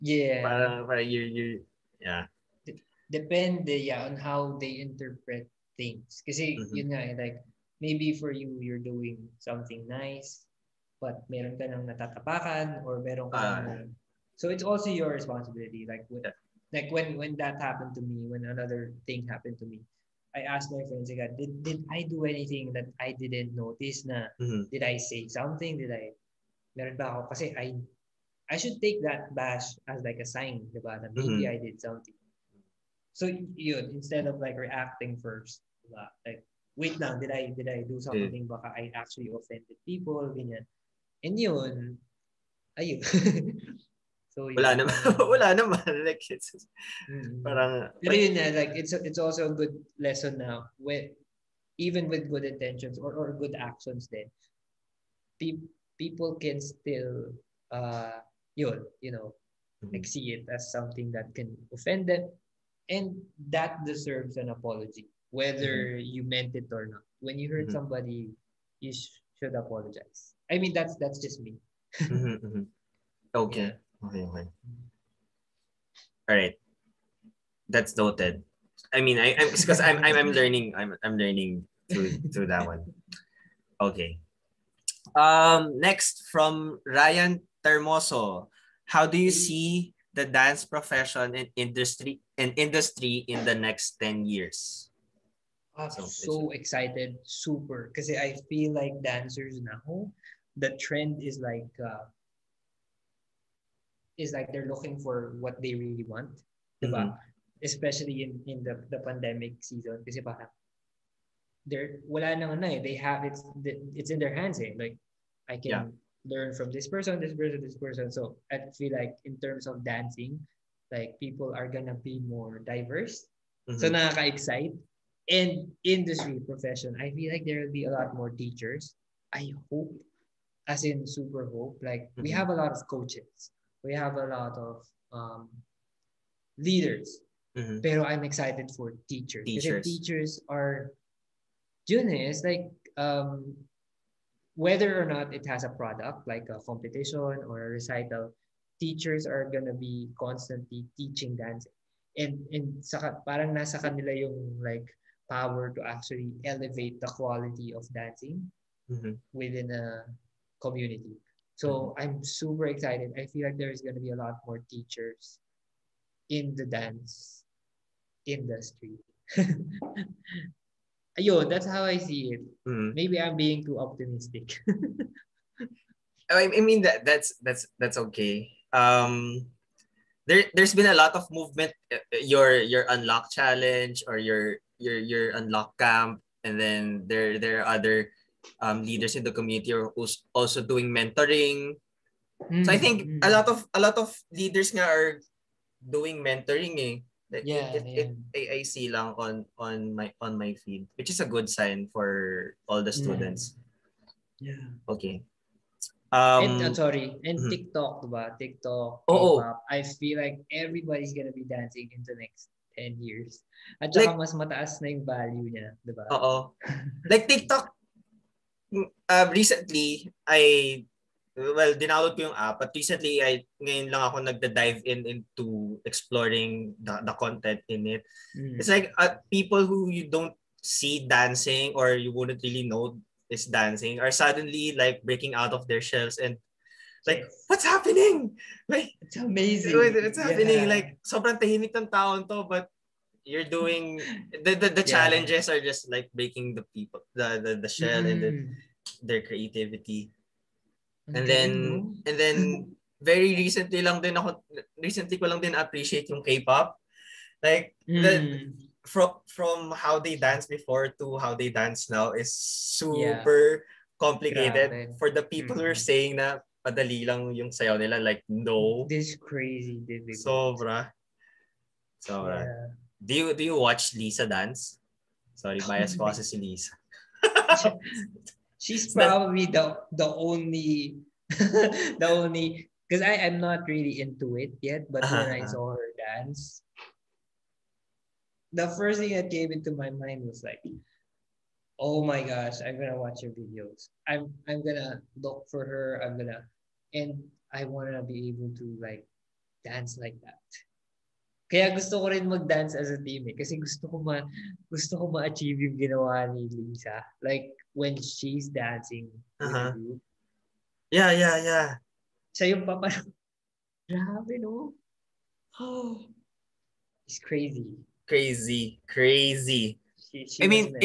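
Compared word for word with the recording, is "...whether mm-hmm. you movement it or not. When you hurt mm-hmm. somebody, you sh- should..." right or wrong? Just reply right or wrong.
wrong.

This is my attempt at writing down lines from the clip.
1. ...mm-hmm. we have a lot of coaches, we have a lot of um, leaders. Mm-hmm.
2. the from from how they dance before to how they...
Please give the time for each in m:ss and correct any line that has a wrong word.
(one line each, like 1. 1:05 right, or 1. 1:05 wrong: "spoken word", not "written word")
1. 2:12 right
2. 4:18 right.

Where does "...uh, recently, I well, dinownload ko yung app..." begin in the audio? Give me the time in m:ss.
3:38.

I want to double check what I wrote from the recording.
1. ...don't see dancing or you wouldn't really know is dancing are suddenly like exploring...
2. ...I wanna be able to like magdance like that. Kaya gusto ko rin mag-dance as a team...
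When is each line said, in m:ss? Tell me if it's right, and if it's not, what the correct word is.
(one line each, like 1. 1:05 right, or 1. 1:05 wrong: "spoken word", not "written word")
1. 3:50 wrong: "breaking", not "exploring"
2. 4:57 wrong: "dance", not "magdance".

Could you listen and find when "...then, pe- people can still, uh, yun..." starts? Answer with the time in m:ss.
0:54.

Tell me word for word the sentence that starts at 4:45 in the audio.
saw her dance, the first thing that came into my mind was like, oh my gosh, I'm gonna watch her videos.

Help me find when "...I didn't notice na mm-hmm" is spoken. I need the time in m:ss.
0:23.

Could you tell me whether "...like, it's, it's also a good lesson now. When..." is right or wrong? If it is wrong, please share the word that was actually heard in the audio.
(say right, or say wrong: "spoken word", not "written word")
right.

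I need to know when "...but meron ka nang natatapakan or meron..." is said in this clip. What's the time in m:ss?
0:11.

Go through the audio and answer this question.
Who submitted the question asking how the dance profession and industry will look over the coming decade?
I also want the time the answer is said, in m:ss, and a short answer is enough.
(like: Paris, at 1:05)
Ryan Termoso, at 1:26.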